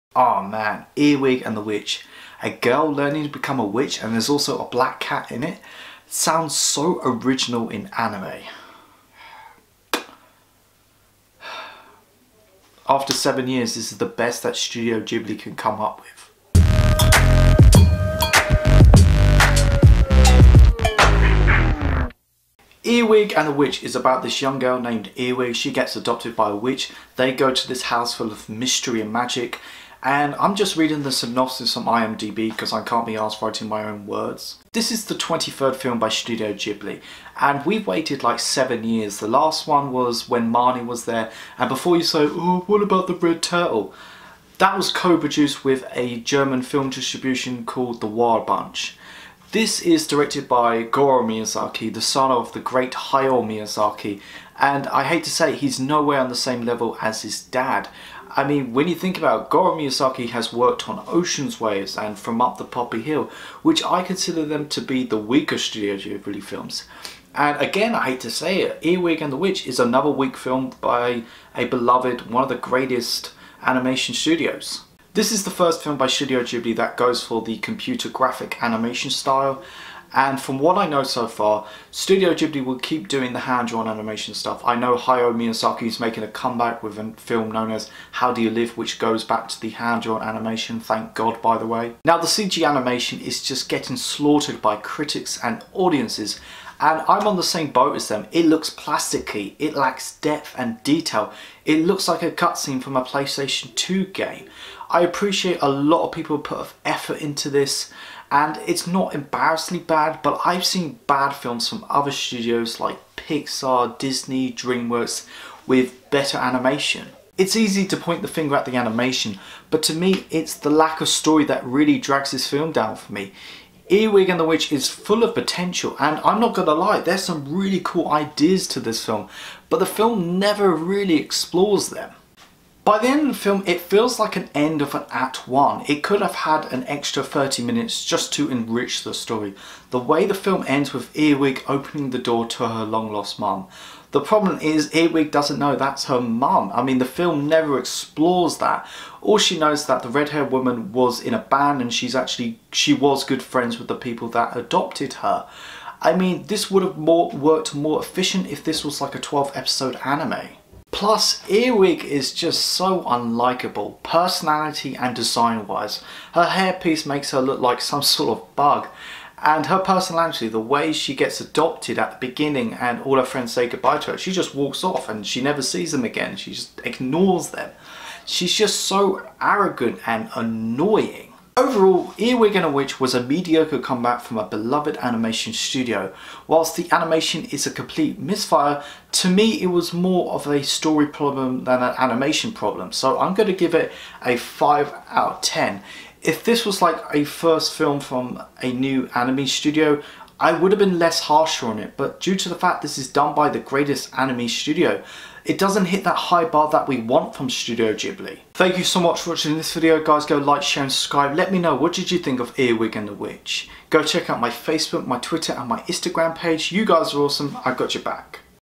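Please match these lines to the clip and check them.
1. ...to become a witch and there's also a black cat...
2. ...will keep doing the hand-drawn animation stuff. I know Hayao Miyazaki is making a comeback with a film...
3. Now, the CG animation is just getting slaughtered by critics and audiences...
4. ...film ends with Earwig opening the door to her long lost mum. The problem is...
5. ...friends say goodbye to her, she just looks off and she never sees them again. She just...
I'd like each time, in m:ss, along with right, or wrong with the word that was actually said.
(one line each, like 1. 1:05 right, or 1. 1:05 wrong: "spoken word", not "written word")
1. 0:03 right
2. 1:22 right
3. 1:32 right
4. 2:20 right
5. 2:53 wrong: "walks", not "looks".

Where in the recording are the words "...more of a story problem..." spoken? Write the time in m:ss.
3:09.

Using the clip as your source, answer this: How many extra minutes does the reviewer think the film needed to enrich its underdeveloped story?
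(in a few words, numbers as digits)
30.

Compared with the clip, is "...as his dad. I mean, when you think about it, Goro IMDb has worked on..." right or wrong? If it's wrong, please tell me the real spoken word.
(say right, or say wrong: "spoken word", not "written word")
wrong: "Miyazaki", not "IMDb".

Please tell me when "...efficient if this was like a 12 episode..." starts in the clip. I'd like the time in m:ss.
2:38.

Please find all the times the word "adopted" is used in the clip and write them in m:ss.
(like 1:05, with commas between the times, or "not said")
0:25, 2:34, 2:51.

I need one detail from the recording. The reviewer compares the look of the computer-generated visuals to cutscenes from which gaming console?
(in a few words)
PlayStation 2.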